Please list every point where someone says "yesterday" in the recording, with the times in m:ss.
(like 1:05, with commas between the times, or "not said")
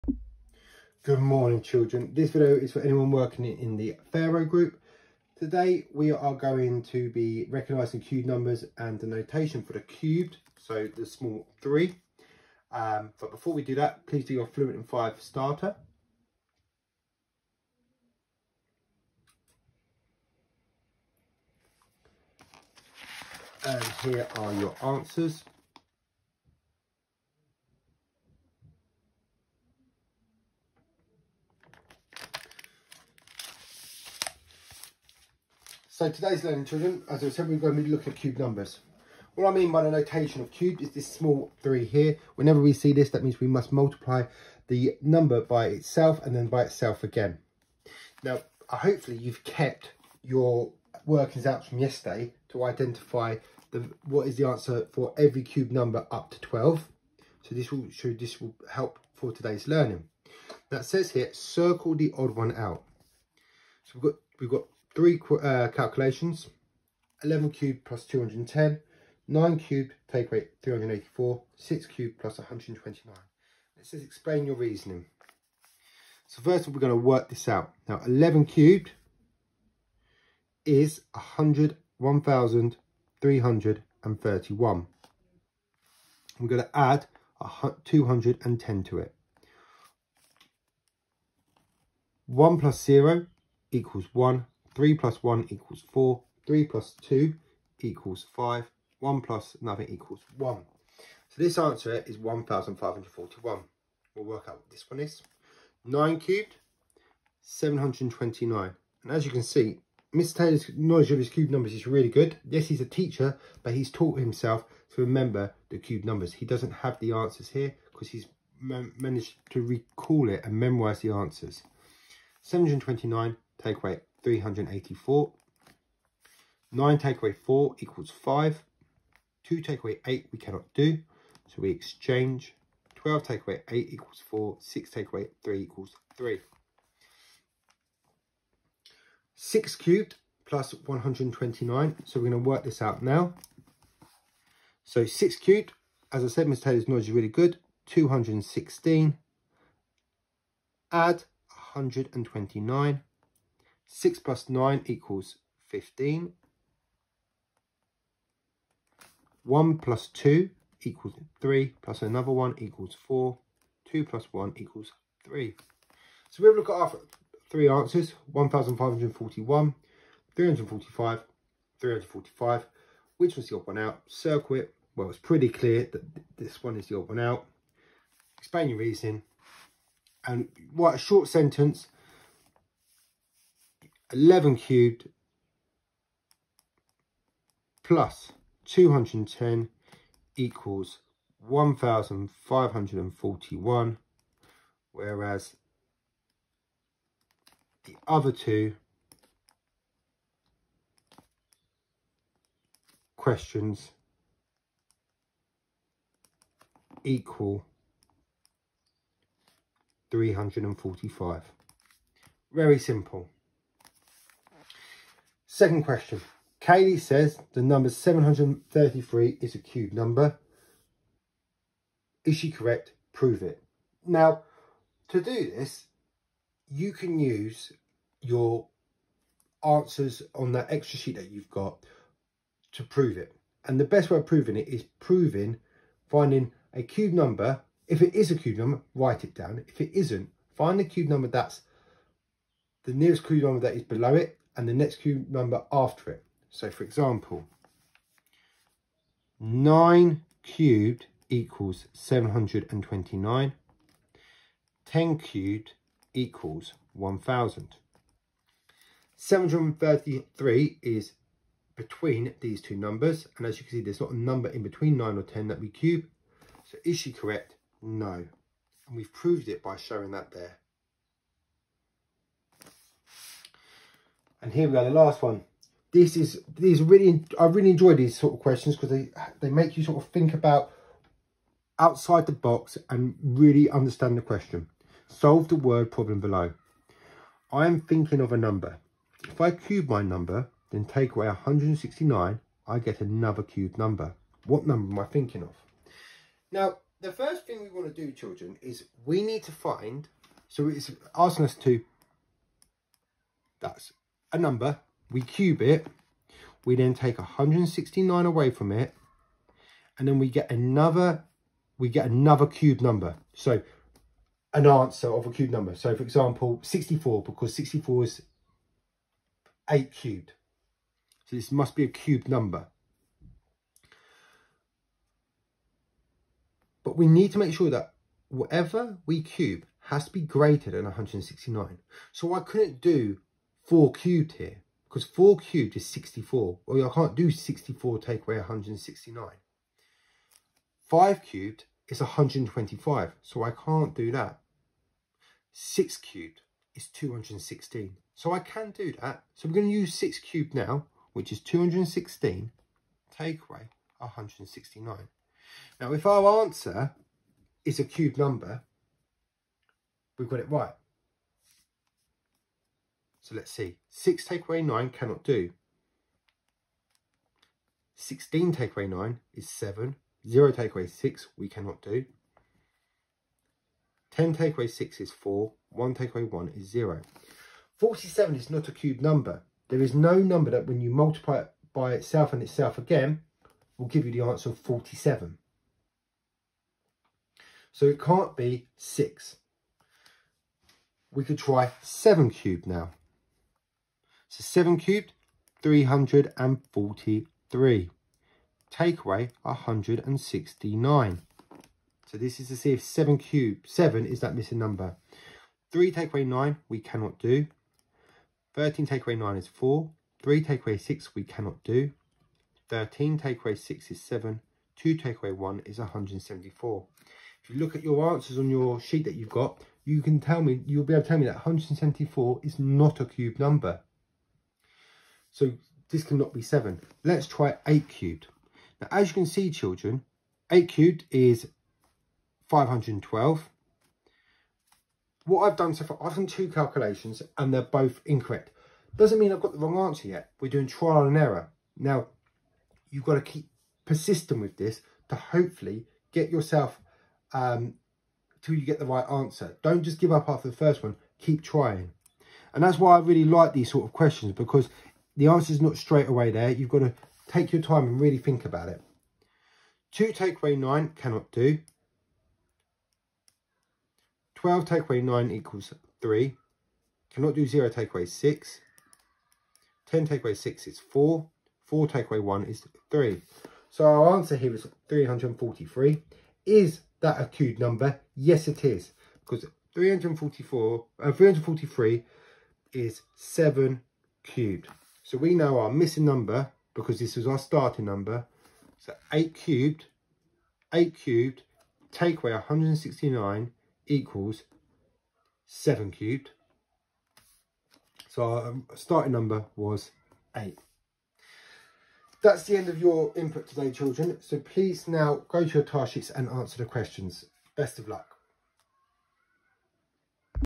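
0:51.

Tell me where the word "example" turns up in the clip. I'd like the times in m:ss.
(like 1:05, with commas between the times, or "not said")
4:06, 5:16.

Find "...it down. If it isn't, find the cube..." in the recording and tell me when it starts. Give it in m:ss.
3:59.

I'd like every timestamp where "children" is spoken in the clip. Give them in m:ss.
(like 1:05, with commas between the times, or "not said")
0:01, 0:36, 4:58, 7:09, 8:23.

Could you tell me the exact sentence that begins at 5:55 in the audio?
Now, if our answer is a cube number, we've got it right.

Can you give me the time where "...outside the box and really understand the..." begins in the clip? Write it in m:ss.
4:41.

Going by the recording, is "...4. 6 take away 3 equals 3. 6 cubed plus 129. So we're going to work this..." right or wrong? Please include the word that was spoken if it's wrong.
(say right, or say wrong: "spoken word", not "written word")
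right.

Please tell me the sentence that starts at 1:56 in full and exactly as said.
He doesn't have the answers here because he's managed to recall it and memorize the answers.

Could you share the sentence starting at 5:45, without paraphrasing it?
6 cubed is 216, so I can do that.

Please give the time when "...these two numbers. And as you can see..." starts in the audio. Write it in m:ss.
4:22.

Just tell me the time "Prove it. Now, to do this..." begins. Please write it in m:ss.
3:43.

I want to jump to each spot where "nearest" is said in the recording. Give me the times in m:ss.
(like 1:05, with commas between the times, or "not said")
4:02.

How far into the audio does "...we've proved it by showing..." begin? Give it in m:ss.
4:28.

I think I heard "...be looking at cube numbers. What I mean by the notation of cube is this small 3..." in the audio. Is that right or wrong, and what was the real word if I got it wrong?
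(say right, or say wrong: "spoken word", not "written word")
right.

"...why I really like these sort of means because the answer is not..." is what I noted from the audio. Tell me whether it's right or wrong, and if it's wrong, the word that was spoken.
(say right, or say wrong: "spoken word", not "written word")
wrong: "questions", not "means".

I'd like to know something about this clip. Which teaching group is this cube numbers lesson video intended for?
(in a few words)
Pharaoh group.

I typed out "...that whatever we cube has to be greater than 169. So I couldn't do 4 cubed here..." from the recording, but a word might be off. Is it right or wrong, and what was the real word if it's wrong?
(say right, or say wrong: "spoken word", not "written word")
right.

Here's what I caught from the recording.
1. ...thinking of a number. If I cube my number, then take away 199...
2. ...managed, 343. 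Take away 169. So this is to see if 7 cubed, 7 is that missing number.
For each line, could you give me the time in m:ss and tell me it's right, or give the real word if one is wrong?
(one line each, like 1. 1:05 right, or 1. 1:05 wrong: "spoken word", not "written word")
1. 4:47 wrong: "169", not "199"
2. 6:34 wrong: "cubed", not "managed".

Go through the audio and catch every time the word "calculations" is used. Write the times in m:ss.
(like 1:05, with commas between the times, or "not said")
1:05, 7:16.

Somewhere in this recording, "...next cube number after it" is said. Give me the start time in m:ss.
4:04.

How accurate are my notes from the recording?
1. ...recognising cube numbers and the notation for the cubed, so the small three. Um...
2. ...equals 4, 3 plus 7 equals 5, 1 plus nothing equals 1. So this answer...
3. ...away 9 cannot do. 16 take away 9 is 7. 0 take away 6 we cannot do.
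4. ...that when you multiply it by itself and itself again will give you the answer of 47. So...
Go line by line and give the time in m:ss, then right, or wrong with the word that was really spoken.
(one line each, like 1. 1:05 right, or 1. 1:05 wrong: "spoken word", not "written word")
1. 0:07 right
2. 1:35 wrong: "2", not "7"
3. 6:04 right
4. 6:20 right.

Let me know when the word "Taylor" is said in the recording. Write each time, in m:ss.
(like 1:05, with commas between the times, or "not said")
1:50, 2:26.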